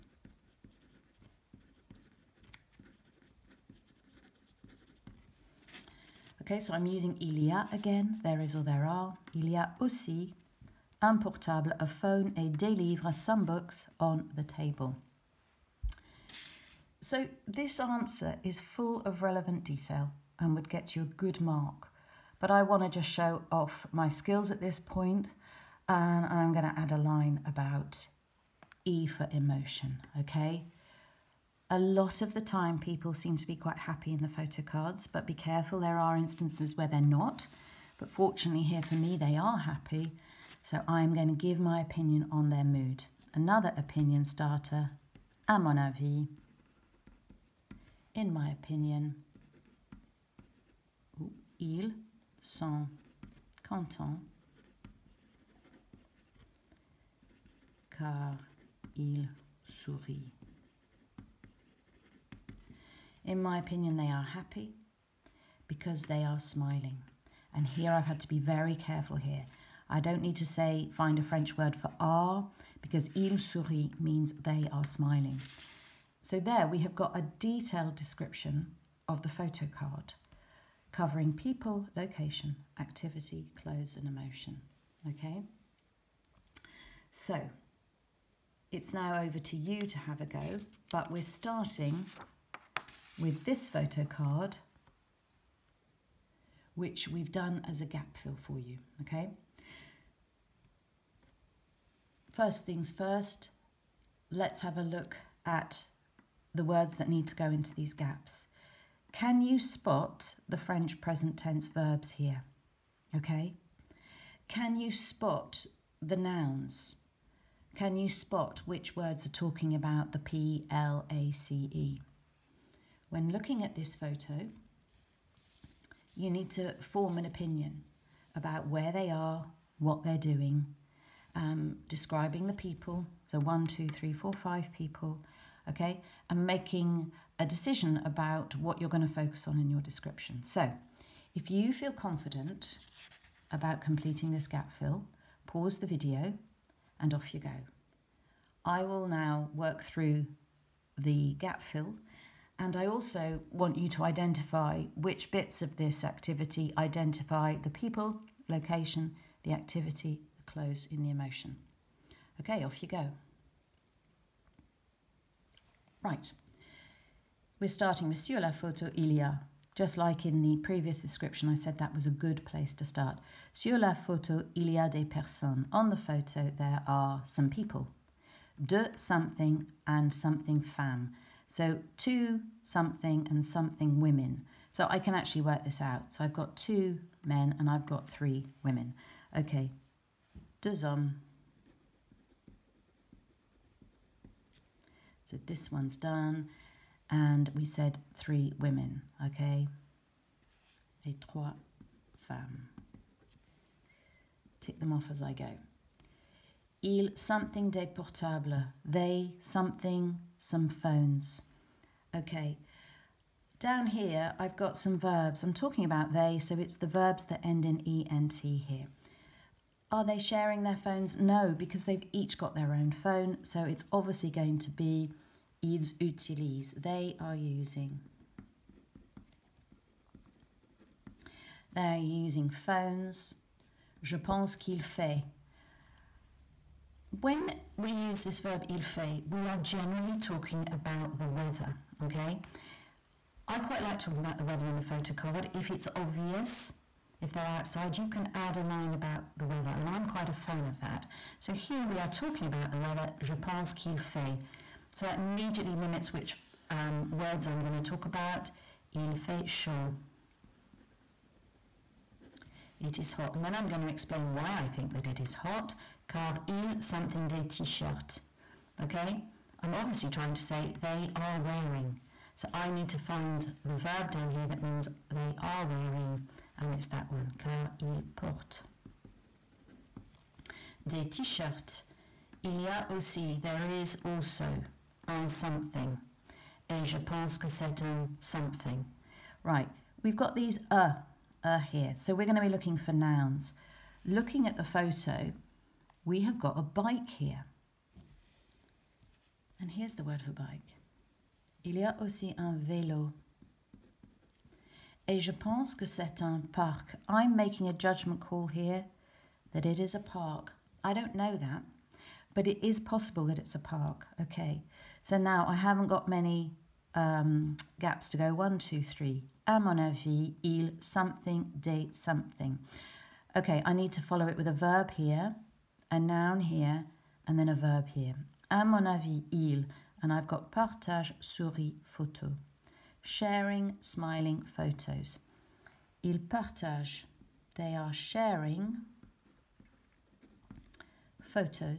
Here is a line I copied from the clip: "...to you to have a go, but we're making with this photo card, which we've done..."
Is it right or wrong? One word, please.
wrong.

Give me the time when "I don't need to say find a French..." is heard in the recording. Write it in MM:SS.
01:09.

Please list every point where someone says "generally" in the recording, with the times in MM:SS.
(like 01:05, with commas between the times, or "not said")
03:59.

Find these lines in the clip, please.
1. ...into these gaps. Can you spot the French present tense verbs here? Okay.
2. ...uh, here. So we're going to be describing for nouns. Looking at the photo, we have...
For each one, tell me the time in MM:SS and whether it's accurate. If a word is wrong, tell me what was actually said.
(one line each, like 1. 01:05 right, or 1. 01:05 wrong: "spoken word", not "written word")
1. 01:47 right
2. 04:51 wrong: "looking", not "describing".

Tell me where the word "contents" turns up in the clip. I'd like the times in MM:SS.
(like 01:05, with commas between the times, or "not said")
00:53.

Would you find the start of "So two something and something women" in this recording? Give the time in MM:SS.
03:01.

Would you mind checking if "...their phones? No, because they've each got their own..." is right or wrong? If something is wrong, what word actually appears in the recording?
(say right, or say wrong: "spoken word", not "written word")
right.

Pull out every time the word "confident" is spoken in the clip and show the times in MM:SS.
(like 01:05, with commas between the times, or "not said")
02:21.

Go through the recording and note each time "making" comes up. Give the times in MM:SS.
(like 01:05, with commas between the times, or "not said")
02:16, 05:07.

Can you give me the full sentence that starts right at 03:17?
And we said three women, okay?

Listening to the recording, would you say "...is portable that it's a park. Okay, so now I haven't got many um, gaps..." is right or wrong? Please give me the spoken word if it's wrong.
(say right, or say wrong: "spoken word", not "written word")
wrong: "possible", not "portable".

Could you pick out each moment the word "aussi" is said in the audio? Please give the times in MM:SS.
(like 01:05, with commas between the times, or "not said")
00:09, 04:42, 05:02.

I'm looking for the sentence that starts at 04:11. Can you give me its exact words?
So here we are talking about the weather, je pense qu'il fait.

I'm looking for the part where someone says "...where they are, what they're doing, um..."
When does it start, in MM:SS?
02:08.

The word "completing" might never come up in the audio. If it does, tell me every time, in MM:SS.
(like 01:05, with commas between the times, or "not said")
02:23.